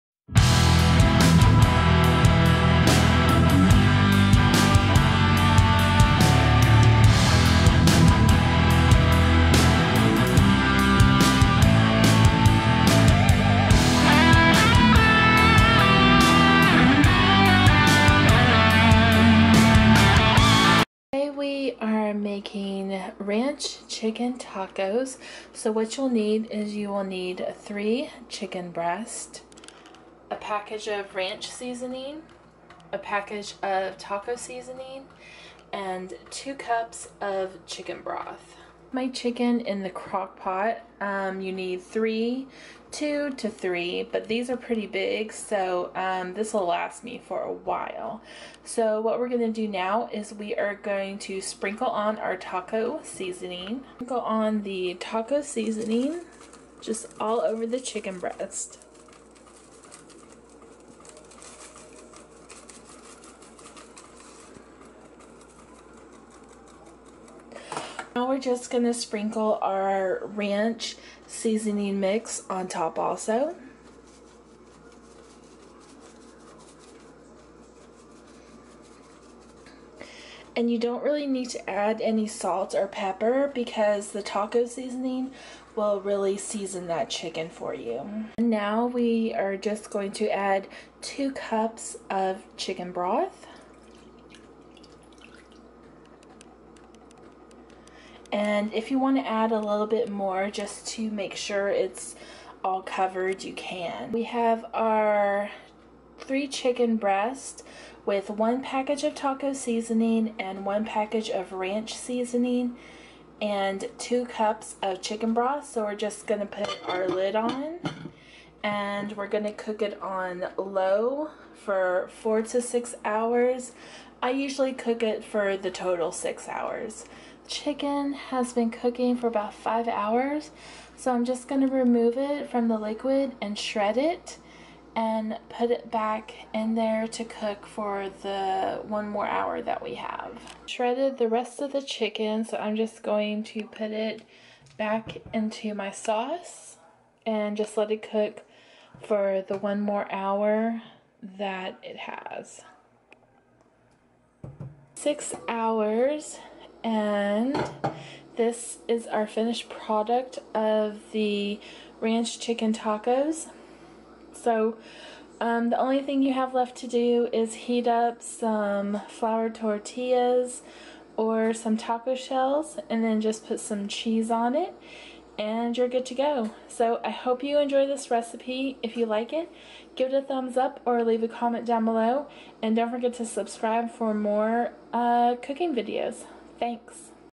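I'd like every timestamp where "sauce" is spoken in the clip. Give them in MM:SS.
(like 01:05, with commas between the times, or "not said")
02:25.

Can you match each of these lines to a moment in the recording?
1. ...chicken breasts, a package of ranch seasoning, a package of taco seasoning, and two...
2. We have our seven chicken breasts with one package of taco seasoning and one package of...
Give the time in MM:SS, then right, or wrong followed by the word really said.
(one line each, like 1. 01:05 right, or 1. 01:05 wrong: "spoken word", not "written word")
1. 00:28 right
2. 01:44 wrong: "three", not "seven".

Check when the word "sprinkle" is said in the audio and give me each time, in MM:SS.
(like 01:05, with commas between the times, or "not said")
00:51, 01:08.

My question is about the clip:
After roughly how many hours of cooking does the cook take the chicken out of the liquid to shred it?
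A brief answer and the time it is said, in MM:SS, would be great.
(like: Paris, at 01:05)
5 hours, at 02:09.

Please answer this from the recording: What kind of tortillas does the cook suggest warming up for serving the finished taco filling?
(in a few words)
flour tortillas.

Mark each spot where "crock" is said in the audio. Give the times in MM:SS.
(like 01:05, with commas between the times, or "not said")
00:39.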